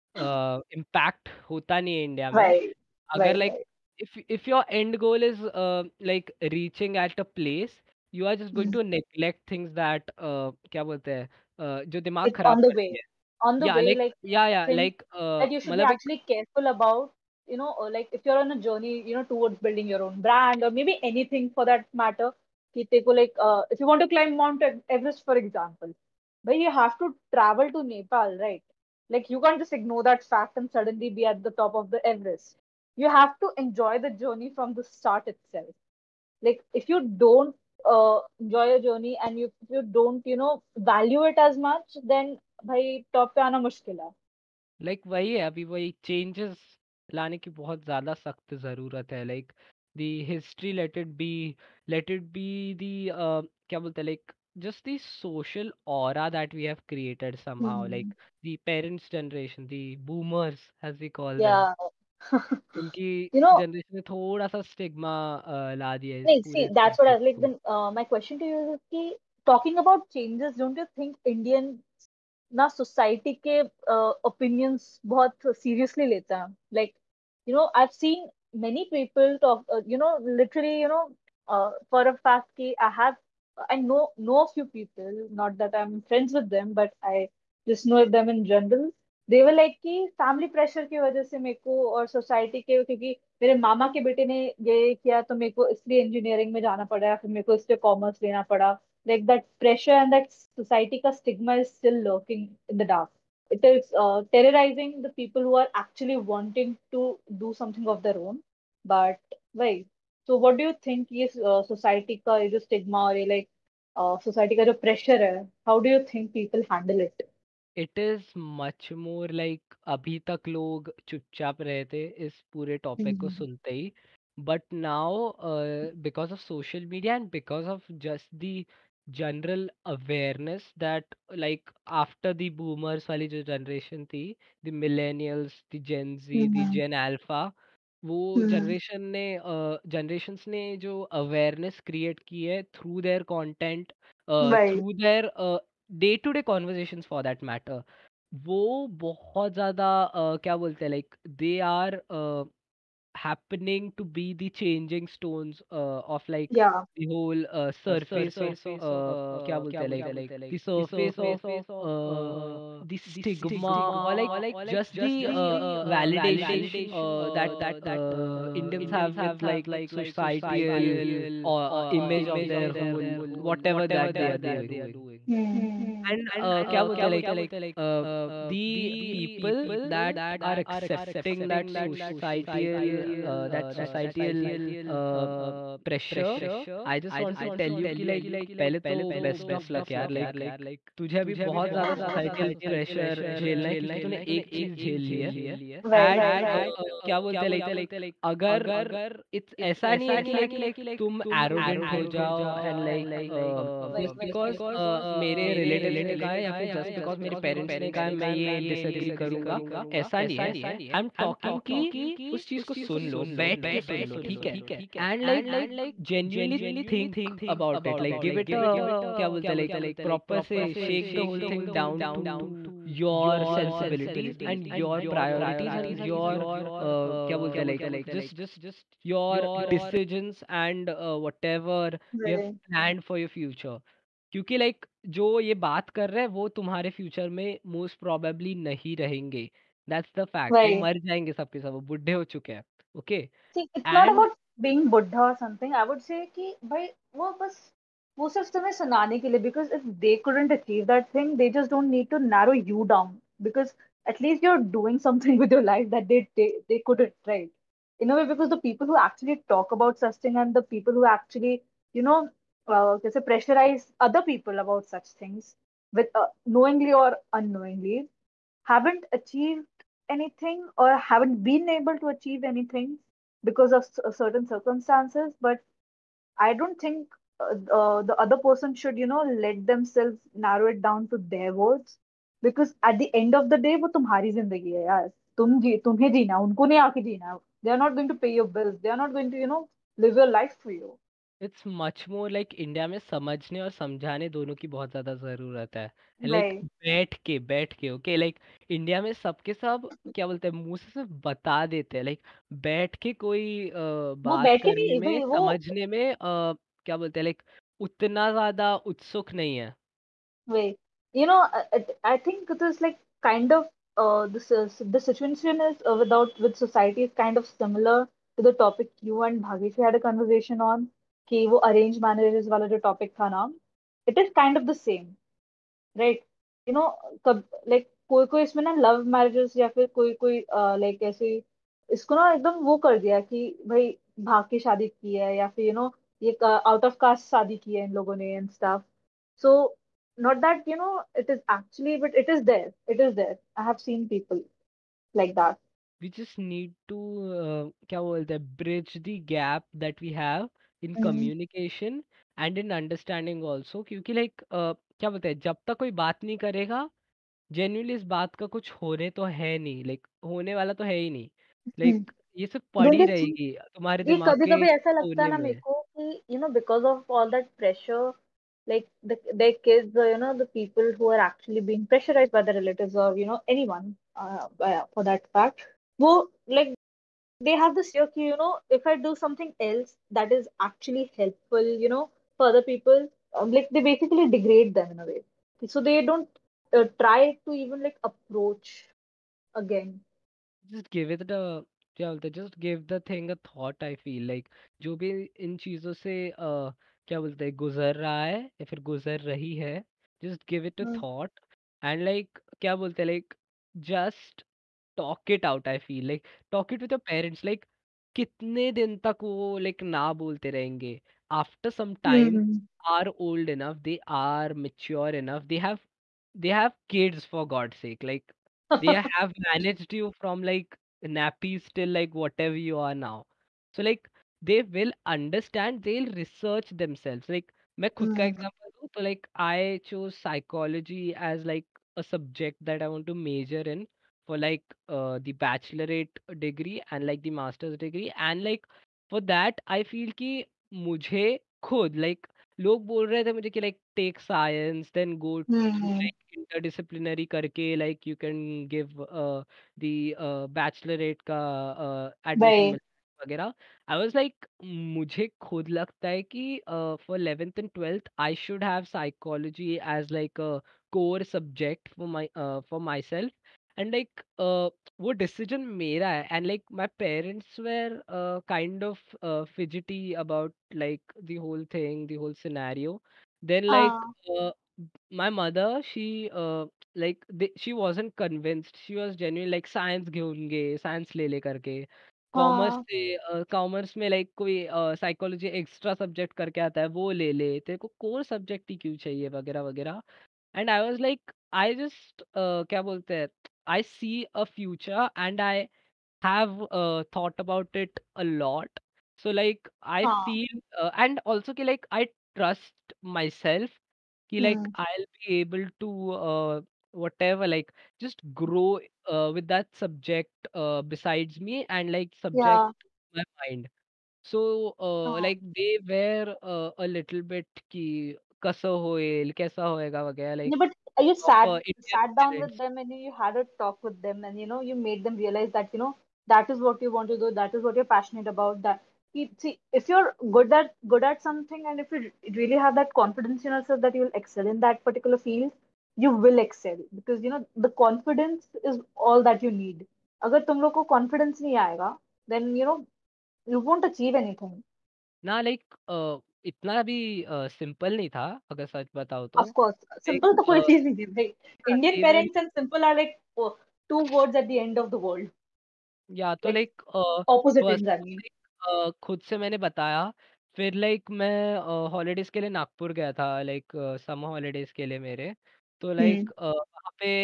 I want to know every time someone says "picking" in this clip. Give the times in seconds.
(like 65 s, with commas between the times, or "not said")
not said.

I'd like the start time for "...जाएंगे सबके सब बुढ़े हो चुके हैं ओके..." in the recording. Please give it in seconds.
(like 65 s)
241 s.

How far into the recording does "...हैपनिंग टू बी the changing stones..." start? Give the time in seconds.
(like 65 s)
153 s.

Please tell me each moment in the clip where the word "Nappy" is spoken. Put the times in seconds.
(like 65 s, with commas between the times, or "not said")
421 s.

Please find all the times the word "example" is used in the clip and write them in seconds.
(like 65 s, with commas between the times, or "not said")
25 s, 428 s.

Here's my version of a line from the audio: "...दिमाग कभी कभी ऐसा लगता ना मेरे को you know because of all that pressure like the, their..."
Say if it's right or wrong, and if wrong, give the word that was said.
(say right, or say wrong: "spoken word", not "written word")
right.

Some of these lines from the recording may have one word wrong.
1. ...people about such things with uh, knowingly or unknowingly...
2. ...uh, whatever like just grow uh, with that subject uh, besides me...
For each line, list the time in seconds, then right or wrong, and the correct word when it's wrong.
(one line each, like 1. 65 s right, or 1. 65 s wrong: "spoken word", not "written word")
1. 264 s right
2. 506 s right.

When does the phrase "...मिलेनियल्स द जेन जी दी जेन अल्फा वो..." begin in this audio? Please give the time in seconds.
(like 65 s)
134 s.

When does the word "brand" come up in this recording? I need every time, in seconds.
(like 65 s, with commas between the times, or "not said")
20 s.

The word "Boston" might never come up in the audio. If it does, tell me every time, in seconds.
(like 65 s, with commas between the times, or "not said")
not said.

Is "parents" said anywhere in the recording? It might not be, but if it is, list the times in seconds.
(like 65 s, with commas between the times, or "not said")
58 s.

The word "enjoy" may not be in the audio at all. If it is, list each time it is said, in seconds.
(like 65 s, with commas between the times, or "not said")
33 s, 38 s.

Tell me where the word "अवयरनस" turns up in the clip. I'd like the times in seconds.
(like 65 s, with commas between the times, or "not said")
129 s, 141 s.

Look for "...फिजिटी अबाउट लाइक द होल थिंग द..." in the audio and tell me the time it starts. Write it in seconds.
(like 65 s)
469 s.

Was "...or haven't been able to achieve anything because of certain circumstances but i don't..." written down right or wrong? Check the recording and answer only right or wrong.
right.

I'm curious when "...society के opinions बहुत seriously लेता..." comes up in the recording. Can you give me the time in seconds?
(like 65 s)
72 s.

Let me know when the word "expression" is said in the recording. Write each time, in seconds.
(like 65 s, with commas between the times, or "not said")
not said.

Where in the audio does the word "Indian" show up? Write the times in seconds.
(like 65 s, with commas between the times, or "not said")
71 s, 168 s.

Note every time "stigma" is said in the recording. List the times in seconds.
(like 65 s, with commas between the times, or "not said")
162 s.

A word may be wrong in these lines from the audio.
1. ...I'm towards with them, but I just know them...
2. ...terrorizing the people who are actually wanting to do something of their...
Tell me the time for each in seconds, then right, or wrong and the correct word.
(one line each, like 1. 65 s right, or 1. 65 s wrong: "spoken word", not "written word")
1. 85 s wrong: "friends", not "towards"
2. 104 s right.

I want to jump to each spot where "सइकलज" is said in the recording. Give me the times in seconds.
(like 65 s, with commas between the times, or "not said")
430 s, 458 s, 485 s.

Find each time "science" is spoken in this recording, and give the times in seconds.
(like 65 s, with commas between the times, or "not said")
479 s.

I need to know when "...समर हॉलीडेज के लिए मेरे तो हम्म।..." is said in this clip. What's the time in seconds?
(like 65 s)
564 s.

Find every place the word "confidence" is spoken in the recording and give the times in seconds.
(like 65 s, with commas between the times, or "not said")
532 s, 537 s.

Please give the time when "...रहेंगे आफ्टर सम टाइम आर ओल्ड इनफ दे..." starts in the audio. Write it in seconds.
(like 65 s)
410 s.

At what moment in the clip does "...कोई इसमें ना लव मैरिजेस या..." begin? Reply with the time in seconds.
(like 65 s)
328 s.